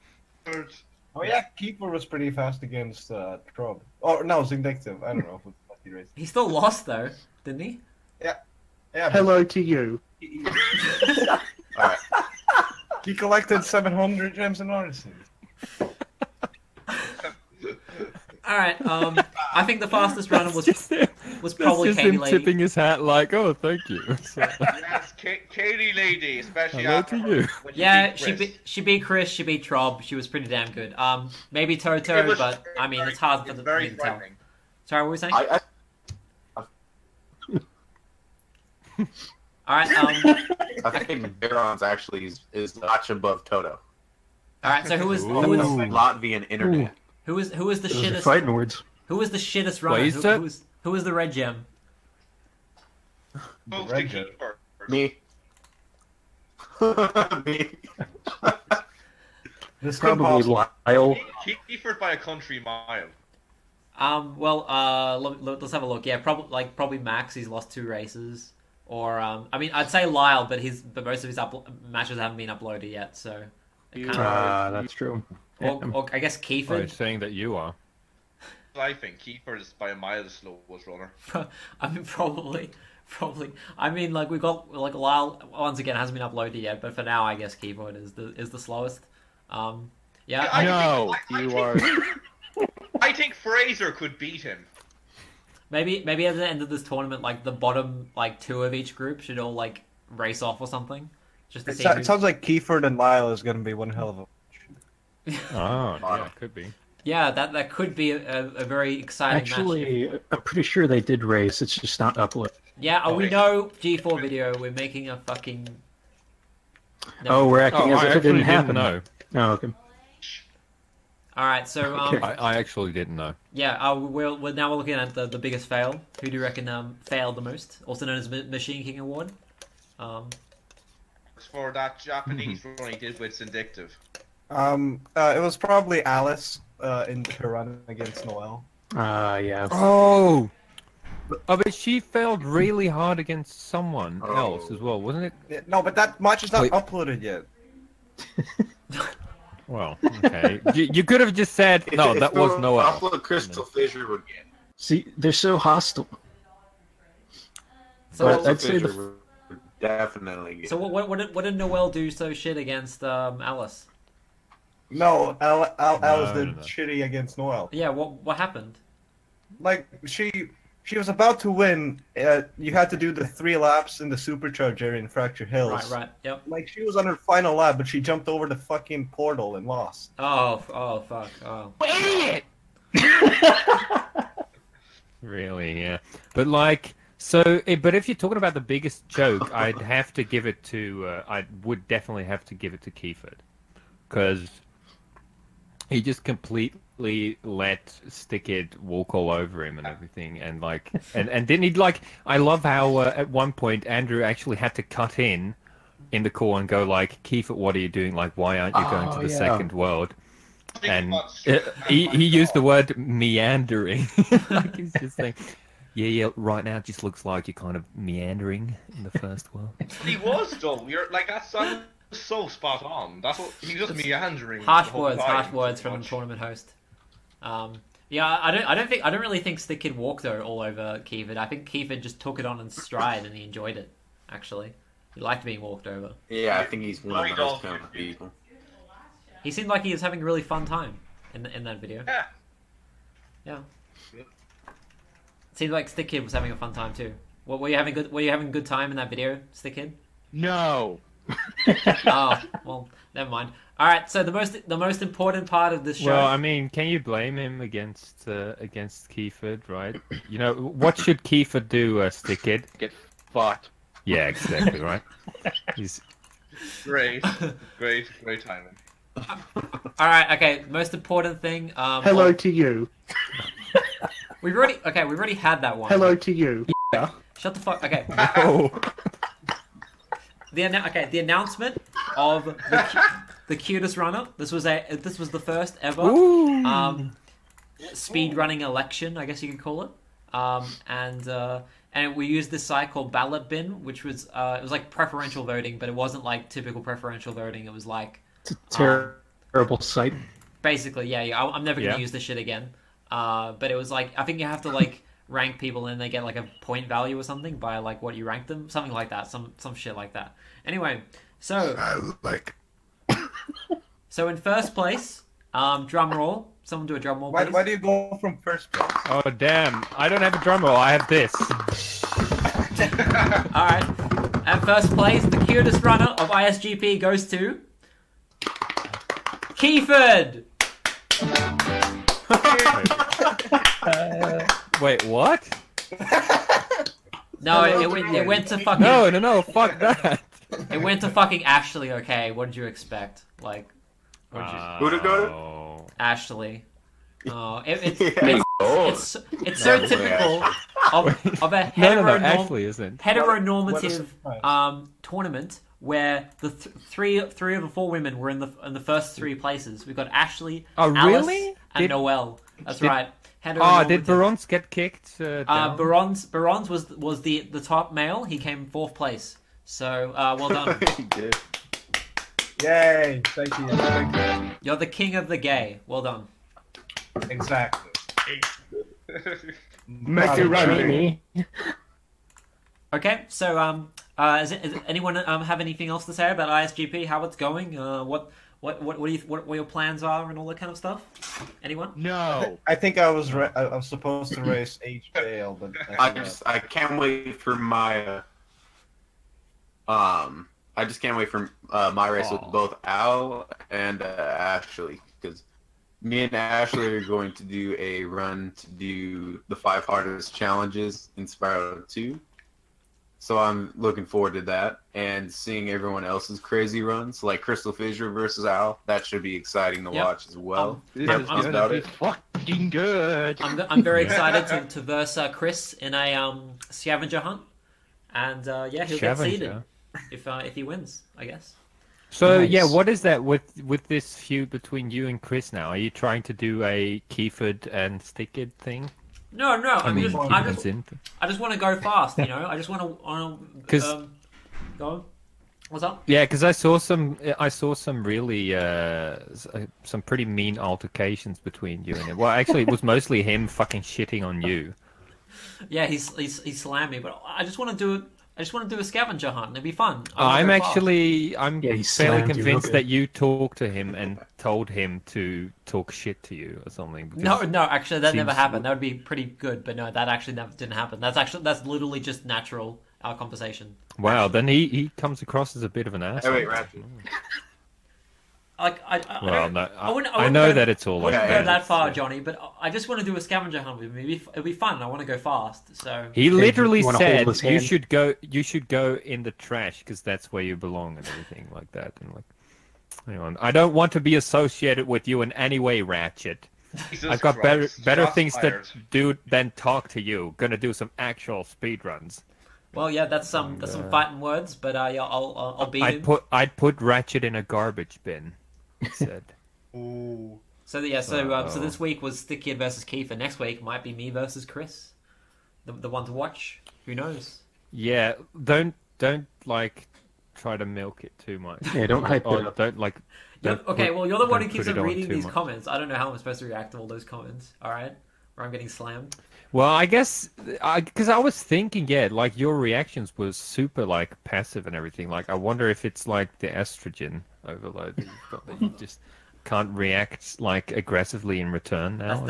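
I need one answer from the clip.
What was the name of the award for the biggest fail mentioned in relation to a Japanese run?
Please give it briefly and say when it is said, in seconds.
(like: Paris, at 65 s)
Machine King Award, at 128 s.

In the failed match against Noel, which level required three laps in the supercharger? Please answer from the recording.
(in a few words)
Fracture Hills.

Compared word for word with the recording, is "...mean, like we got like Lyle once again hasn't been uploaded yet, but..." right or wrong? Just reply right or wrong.
right.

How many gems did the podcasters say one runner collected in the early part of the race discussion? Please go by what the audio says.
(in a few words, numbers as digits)
700.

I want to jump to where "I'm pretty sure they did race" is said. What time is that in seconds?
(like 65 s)
110 s.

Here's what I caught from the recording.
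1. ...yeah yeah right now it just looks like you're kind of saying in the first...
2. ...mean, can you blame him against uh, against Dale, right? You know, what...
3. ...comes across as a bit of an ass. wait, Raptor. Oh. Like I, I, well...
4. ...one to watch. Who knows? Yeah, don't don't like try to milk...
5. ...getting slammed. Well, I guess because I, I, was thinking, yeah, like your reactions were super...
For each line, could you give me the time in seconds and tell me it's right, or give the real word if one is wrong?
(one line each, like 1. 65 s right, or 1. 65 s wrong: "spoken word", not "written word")
1. 215 s wrong: "meandering", not "saying"
2. 256 s wrong: "Keyford", not "Dale"
3. 474 s right
4. 515 s right
5. 528 s right.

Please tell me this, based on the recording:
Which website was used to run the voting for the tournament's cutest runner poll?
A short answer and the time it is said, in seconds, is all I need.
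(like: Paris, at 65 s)
Ballot Bin, at 293 s.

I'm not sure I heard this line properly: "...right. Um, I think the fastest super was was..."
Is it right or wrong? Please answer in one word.
wrong.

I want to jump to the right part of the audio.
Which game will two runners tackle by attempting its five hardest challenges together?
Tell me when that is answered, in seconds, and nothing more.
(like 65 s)
411 s.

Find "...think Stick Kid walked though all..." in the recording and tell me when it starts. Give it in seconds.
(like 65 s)
229 s.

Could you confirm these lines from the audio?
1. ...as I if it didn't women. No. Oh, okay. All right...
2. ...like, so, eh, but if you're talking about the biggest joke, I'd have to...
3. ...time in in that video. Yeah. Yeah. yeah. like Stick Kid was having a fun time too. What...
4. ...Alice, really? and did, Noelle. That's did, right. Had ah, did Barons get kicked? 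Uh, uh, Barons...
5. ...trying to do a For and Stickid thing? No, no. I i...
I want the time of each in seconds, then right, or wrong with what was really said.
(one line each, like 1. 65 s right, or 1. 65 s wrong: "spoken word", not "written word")
1. 117 s wrong: "happen", not "women"
2. 186 s right
3. 240 s right
4. 360 s right
5. 435 s wrong: "Keyford", not "For".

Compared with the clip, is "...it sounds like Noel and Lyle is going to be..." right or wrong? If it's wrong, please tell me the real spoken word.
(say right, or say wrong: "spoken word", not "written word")
wrong: "Keyford", not "Noel".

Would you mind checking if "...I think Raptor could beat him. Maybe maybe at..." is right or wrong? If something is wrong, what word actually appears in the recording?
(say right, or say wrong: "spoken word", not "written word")
wrong: "Fraser", not "Raptor".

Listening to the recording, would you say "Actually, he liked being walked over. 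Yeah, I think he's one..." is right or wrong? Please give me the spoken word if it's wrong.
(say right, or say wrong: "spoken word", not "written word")
right.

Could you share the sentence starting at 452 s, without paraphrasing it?
Well, actually, it was mostly him fucking shitting on you.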